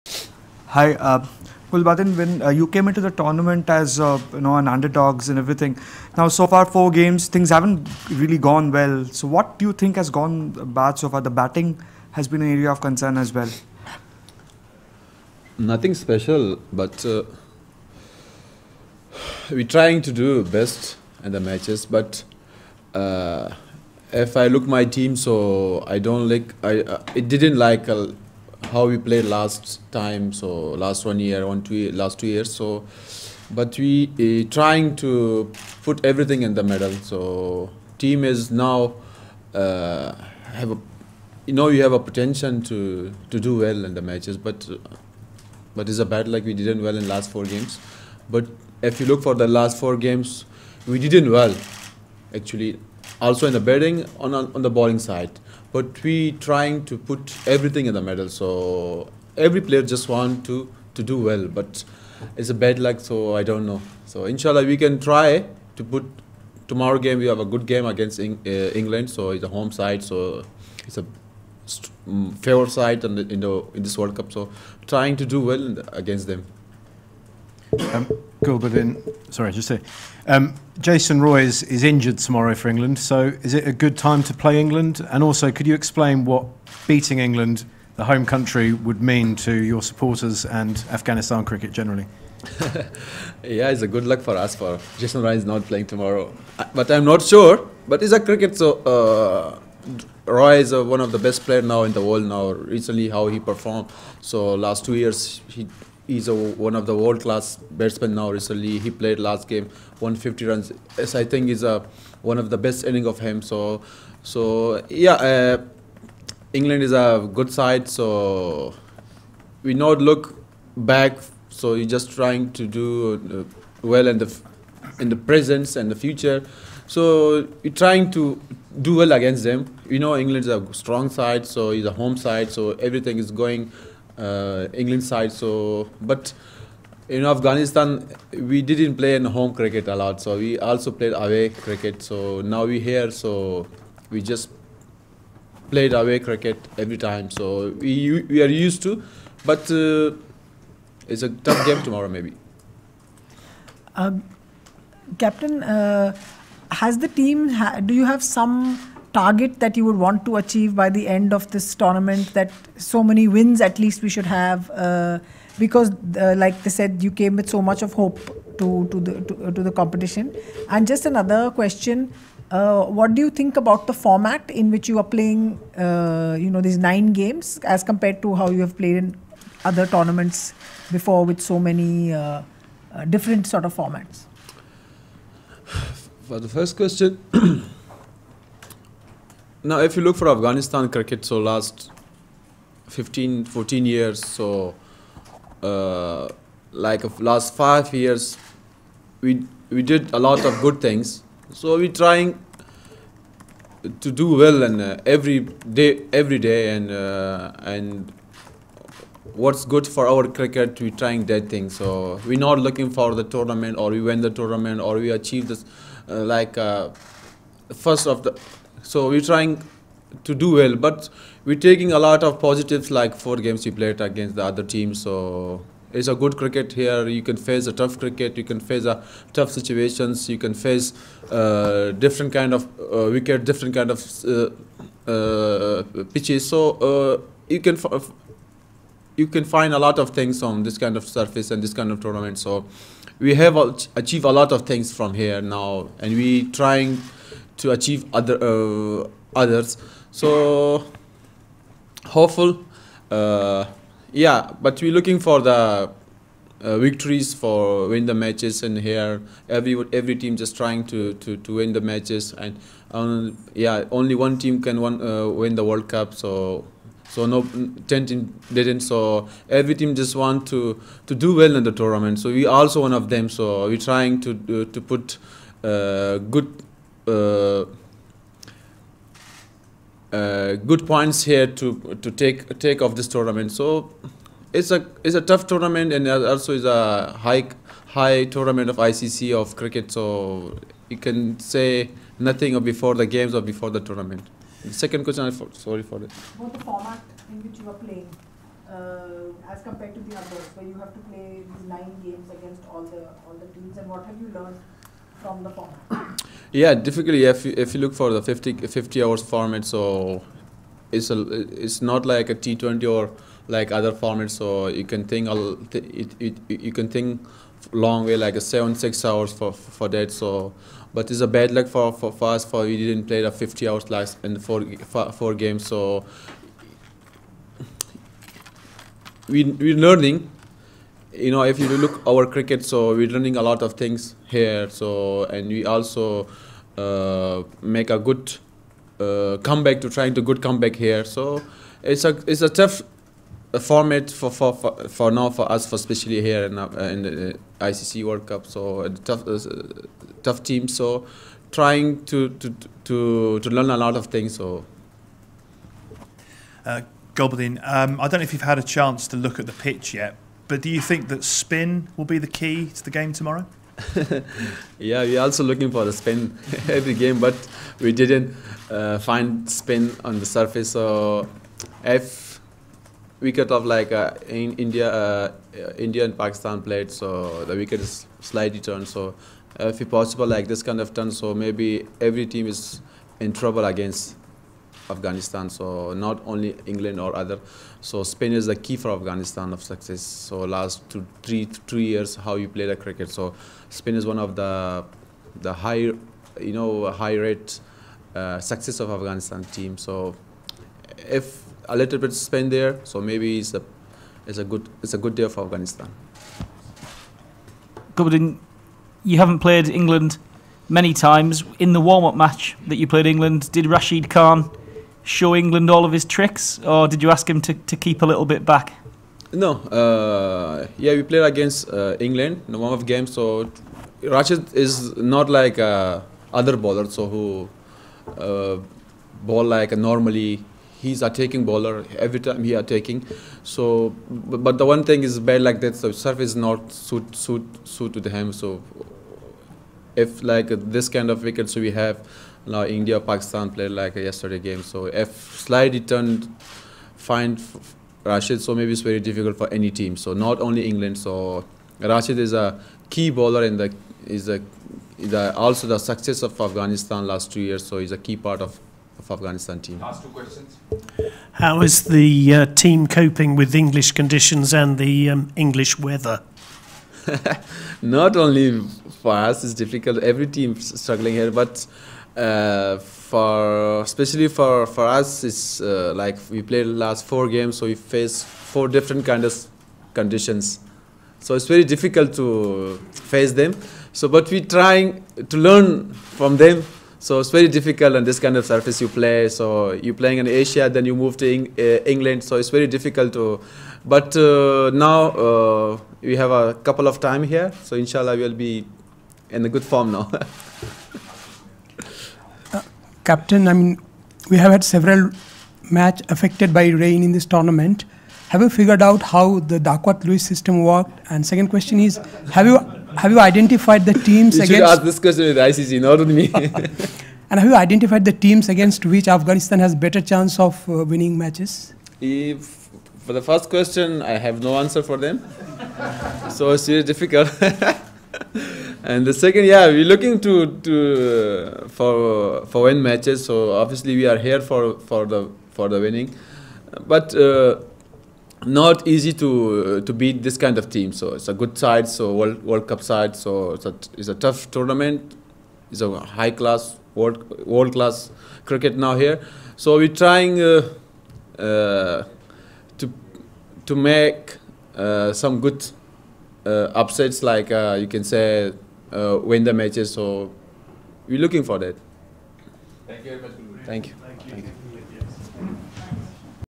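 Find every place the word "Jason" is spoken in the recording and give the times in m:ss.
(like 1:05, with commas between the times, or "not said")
1:20, 1:34.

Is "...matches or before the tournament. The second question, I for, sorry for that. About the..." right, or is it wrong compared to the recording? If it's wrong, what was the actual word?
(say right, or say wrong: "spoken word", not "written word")
wrong: "games", not "matches".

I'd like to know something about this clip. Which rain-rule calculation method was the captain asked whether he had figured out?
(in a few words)
Duckworth-Lewis.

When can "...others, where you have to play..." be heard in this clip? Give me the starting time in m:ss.
5:00.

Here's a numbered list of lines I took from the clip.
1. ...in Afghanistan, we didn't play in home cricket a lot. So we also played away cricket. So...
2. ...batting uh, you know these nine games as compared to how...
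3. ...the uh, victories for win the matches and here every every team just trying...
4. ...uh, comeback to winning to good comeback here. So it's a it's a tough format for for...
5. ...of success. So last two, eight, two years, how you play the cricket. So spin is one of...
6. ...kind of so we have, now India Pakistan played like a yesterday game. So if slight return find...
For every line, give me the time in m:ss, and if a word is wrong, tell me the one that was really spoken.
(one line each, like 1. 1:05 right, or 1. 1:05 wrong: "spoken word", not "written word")
1. 2:17 right
2. 2:55 wrong: "playing", not "batting"
3. 4:15 right
4. 5:38 wrong: "trying", not "winning"
5. 6:29 wrong: "three", not "eight"
6. 7:20 right.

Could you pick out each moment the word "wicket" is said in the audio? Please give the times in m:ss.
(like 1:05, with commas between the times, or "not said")
3:53, 6:13, 6:17.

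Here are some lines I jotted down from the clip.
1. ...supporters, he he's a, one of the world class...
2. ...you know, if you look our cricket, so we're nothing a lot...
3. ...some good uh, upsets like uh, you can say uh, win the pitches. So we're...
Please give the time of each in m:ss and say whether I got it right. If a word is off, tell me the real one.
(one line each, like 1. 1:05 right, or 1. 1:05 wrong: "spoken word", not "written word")
1. 1:44 wrong: "years", not "supporters"
2. 5:31 wrong: "learning", not "nothing"
3. 9:15 wrong: "matches", not "pitches".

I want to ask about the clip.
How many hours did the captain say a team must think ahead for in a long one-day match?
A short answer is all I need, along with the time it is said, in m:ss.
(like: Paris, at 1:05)
6, at 5:18.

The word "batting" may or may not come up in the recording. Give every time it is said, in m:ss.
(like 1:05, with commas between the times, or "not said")
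0:11, 0:53.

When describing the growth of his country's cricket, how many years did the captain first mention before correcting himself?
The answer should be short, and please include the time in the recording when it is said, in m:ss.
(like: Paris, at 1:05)
15, at 3:12.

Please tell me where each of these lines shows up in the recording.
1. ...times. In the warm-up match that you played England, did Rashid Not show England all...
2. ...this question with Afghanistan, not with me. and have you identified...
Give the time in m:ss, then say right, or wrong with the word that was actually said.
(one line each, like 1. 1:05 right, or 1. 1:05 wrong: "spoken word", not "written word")
1. 6:50 wrong: "Khan", not "Not"
2. 8:34 wrong: "ICC", not "Afghanistan".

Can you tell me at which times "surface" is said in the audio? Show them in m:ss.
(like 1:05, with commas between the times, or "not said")
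4:01, 6:10, 7:15, 8:08.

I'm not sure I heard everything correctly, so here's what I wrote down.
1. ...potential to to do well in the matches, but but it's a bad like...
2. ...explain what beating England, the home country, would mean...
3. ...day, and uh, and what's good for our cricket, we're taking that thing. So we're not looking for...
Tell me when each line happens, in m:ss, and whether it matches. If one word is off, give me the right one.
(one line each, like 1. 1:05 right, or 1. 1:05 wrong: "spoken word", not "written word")
1. 0:41 right
2. 1:25 right
3. 3:26 wrong: "trying", not "taking".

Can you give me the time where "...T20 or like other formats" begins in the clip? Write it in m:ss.
5:12.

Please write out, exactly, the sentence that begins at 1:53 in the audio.
So so yeah, uh, England is a good side.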